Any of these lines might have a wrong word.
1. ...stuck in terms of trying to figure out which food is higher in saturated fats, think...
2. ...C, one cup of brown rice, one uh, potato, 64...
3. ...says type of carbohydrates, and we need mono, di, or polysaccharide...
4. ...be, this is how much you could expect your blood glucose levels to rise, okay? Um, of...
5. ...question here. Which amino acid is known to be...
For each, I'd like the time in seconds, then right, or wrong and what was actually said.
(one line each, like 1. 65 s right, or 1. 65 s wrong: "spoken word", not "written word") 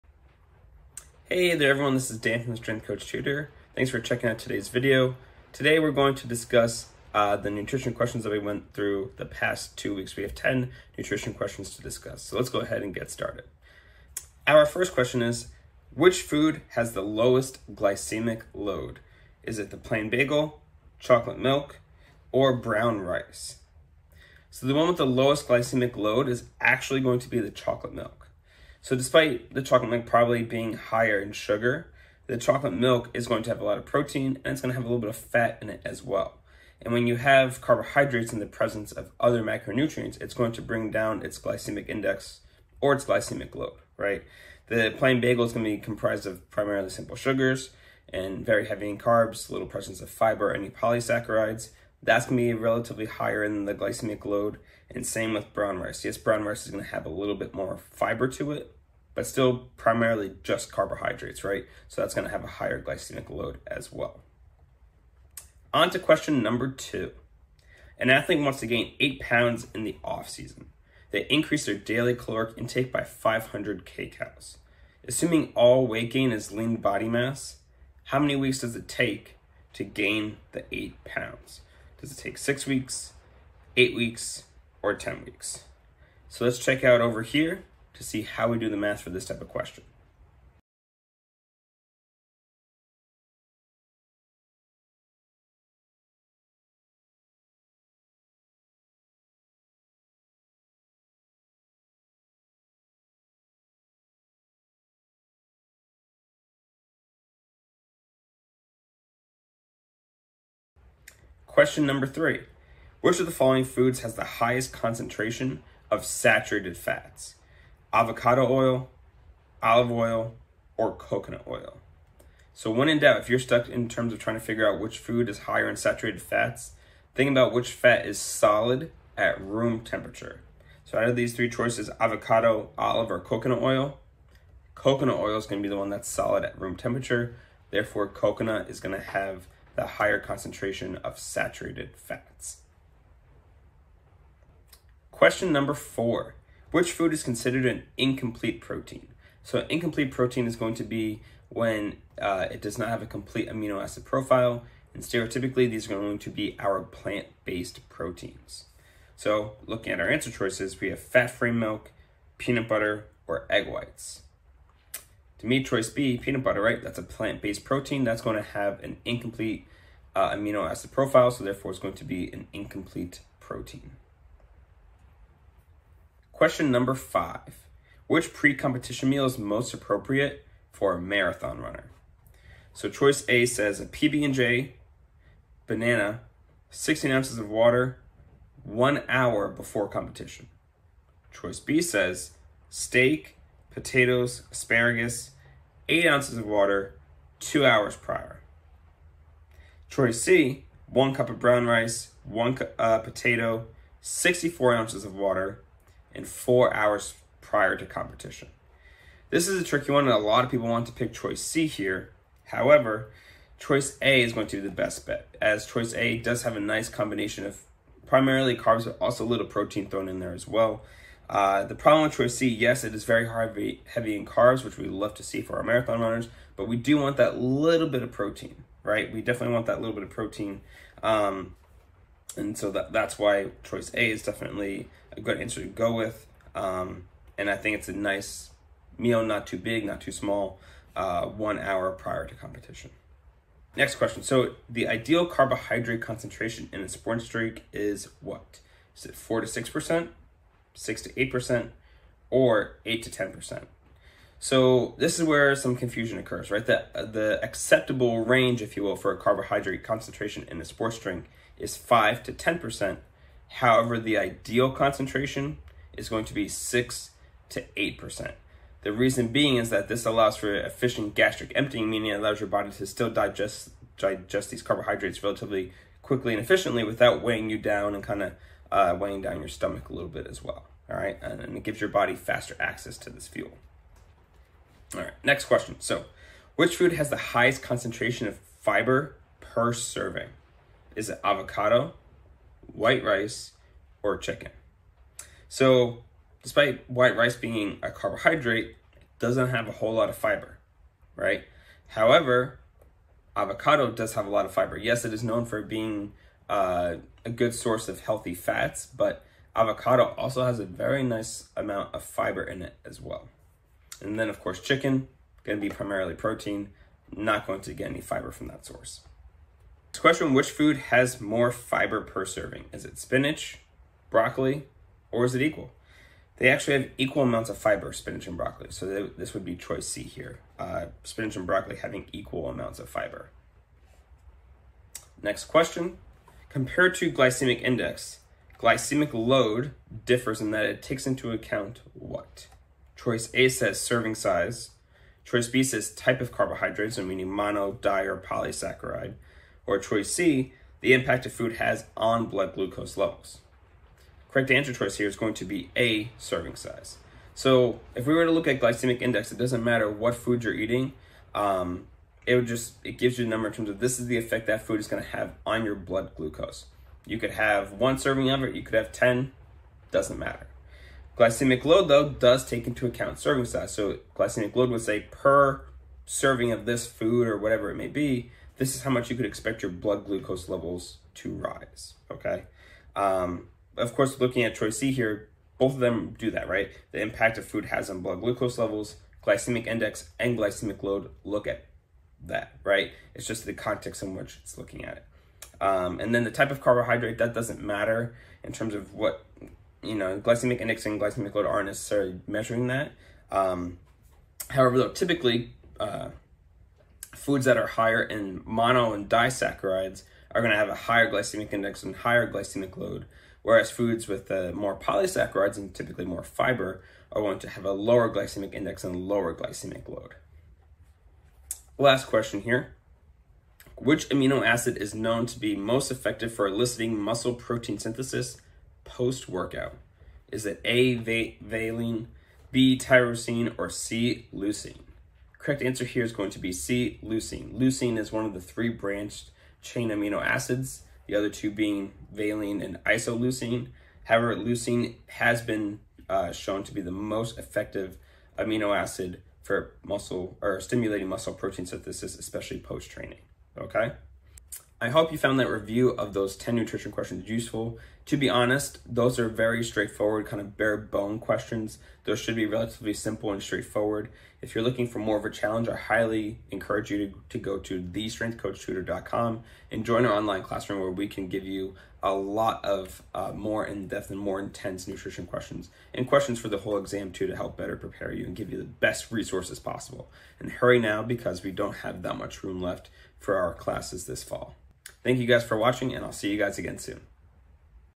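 1. 123 s right
2. 200 s right
3. 345 s right
4. 377 s right
5. 422 s right.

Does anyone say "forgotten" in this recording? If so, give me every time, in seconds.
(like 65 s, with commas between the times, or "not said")
not said.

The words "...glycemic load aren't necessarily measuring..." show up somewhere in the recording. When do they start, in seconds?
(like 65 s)
401 s.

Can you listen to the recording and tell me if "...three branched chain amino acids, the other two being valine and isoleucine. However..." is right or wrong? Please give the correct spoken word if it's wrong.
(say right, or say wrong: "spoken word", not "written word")
right.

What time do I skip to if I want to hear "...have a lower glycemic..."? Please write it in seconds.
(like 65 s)
417 s.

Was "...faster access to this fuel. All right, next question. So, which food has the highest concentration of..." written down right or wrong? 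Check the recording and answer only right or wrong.
right.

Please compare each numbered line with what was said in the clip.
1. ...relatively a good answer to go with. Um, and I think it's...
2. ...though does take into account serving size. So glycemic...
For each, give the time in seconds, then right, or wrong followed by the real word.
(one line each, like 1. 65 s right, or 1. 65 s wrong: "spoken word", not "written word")
1. 234 s wrong: "definitely", not "relatively"
2. 371 s right.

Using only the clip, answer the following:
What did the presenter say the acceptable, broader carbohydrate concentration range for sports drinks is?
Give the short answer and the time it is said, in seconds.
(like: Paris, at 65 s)
5 to 10%, at 261 s.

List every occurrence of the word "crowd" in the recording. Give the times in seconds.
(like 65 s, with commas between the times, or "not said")
not said.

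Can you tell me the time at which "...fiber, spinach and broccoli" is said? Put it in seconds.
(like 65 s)
327 s.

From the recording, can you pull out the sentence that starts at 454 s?
I hope you found that review of those 10 nutrition questions useful.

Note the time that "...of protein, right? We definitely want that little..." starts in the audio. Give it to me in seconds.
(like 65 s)
228 s.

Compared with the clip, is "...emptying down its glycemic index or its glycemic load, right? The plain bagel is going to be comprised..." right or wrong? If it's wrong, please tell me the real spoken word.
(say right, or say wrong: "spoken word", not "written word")
wrong: "bring", not "emptying".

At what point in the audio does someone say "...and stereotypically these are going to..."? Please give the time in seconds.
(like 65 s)
154 s.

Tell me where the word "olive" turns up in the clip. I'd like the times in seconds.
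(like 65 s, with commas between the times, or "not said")
119 s, 132 s.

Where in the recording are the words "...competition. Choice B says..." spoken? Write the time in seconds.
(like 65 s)
189 s.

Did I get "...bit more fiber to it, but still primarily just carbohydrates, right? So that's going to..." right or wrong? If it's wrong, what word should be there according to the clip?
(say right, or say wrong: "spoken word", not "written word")
right.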